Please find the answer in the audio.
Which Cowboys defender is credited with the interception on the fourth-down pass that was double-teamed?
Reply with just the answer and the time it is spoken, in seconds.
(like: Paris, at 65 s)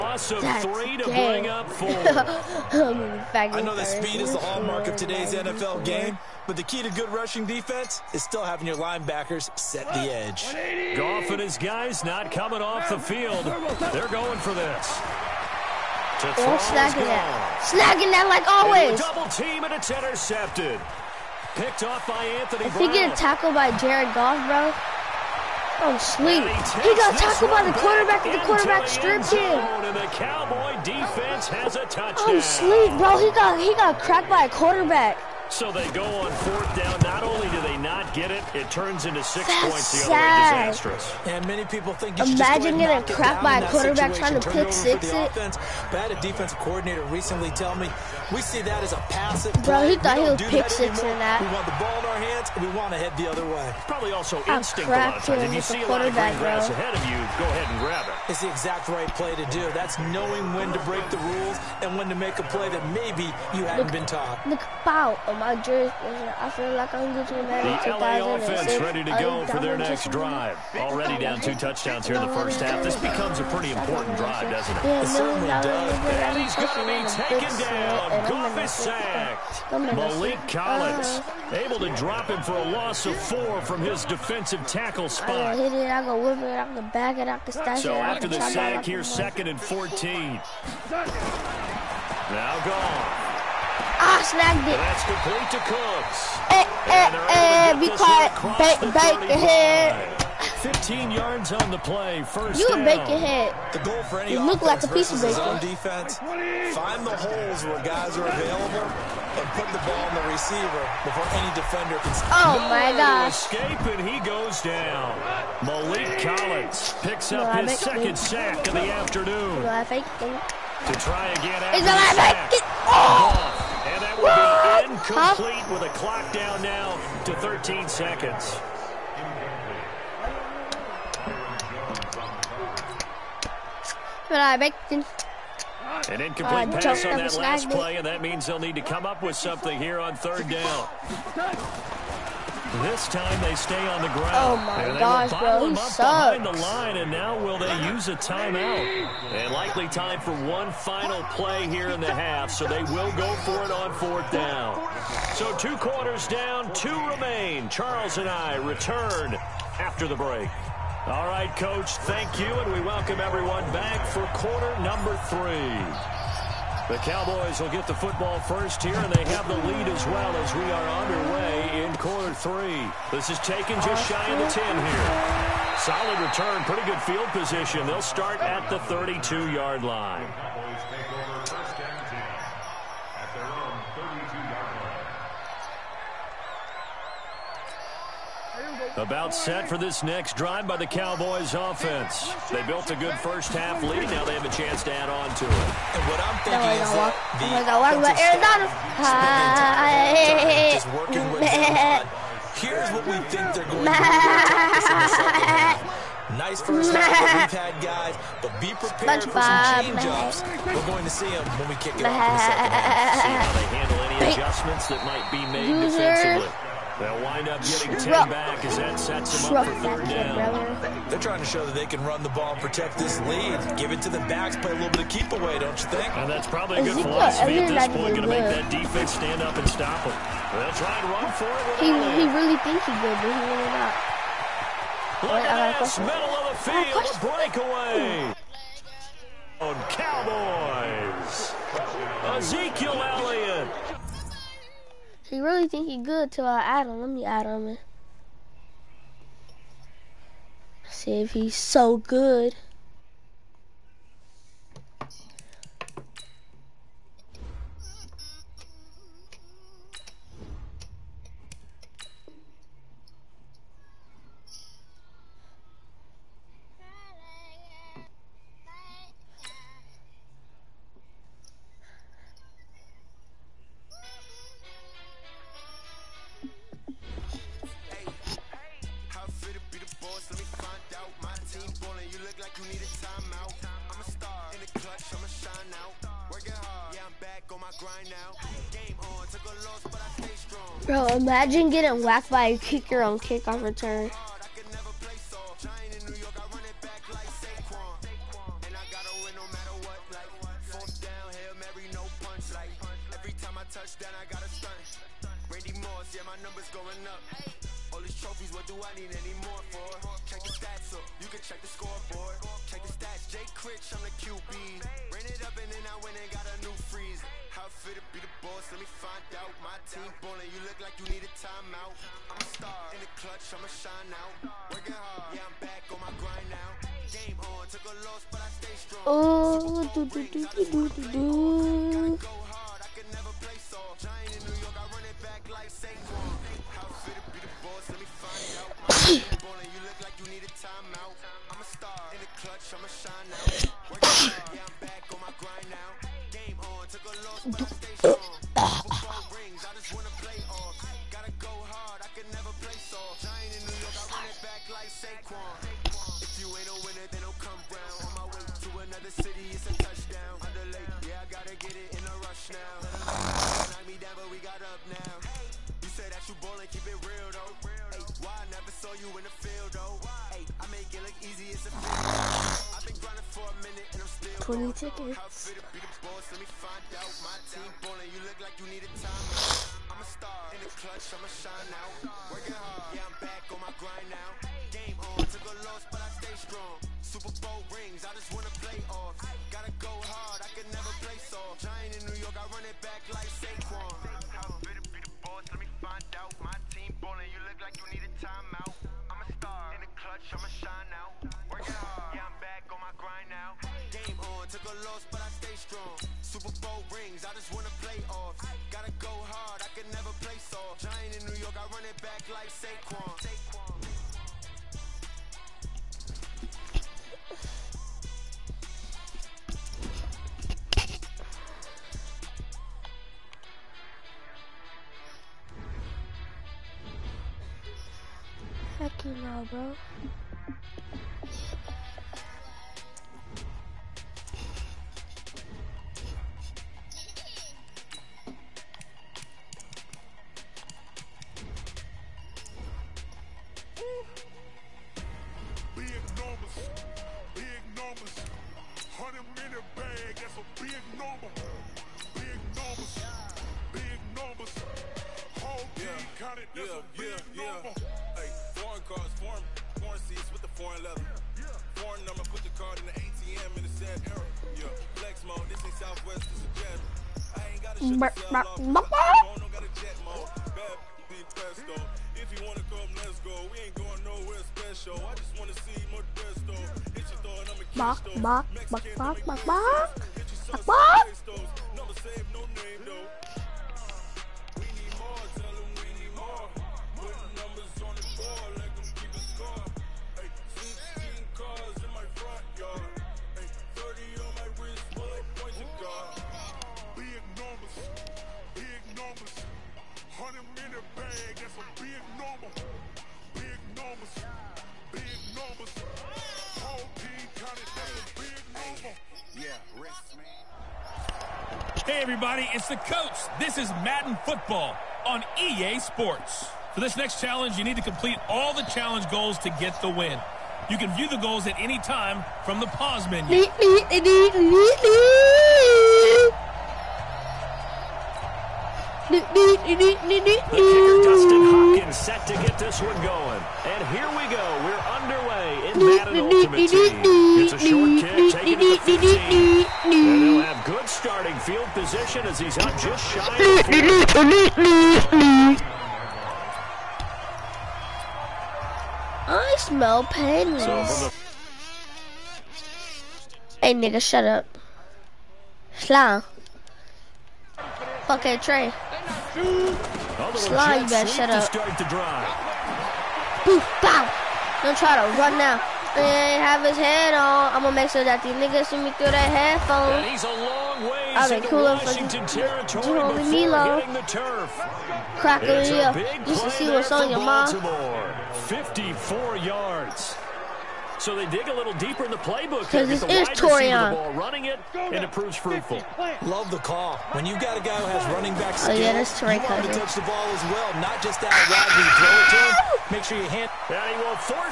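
Anthony, at 22 s.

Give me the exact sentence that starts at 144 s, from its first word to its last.
Oh my gosh, bro, he sucks.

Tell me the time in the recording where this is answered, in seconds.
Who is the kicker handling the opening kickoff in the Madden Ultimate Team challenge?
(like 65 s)
531 s.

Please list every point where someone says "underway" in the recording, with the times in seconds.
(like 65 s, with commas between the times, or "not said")
171 s, 534 s.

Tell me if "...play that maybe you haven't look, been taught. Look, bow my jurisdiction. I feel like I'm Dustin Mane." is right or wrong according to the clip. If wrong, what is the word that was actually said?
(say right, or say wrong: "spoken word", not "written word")
wrong: "Gucci", not "Dustin".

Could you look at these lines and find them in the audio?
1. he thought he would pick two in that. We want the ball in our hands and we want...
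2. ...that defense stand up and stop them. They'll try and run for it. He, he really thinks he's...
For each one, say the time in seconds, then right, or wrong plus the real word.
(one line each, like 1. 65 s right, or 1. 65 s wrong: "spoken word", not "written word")
1. 49 s wrong: "six", not "two"
2. 228 s right.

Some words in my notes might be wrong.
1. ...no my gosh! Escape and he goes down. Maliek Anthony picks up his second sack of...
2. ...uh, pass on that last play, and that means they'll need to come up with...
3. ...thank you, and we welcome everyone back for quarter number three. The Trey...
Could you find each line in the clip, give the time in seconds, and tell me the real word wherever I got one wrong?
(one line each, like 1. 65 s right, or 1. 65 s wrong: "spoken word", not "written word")
1. 112 s wrong: "Collins", not "Anthony"
2. 136 s right
3. 161 s wrong: "Cowboys", not "Trey".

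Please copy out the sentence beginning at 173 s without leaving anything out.
This is taken just shy of the 10 here.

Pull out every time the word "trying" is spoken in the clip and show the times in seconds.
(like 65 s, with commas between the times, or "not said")
44 s, 221 s.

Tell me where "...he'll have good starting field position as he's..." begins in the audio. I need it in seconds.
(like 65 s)
539 s.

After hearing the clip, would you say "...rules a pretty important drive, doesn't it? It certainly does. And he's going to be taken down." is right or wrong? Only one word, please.
wrong.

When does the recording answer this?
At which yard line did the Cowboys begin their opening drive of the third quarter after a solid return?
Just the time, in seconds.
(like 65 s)
178 s.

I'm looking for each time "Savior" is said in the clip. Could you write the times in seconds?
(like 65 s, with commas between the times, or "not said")
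not said.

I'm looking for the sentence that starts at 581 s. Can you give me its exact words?
So they dig a little deeper in the playbook.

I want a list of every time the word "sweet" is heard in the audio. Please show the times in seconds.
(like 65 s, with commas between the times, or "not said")
26 s, 32 s.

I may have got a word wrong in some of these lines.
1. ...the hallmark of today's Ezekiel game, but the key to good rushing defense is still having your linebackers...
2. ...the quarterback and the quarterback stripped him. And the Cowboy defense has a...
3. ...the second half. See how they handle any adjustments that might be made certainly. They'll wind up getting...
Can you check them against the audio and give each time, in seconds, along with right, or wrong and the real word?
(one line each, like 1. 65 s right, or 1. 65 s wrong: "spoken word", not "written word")
1. 4 s wrong: "NFL", not "Ezekiel"
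2. 27 s right
3. 212 s wrong: "defensively", not "certainly".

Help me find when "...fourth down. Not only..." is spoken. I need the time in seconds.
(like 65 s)
36 s.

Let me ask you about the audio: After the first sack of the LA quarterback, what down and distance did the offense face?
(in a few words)
second and 14.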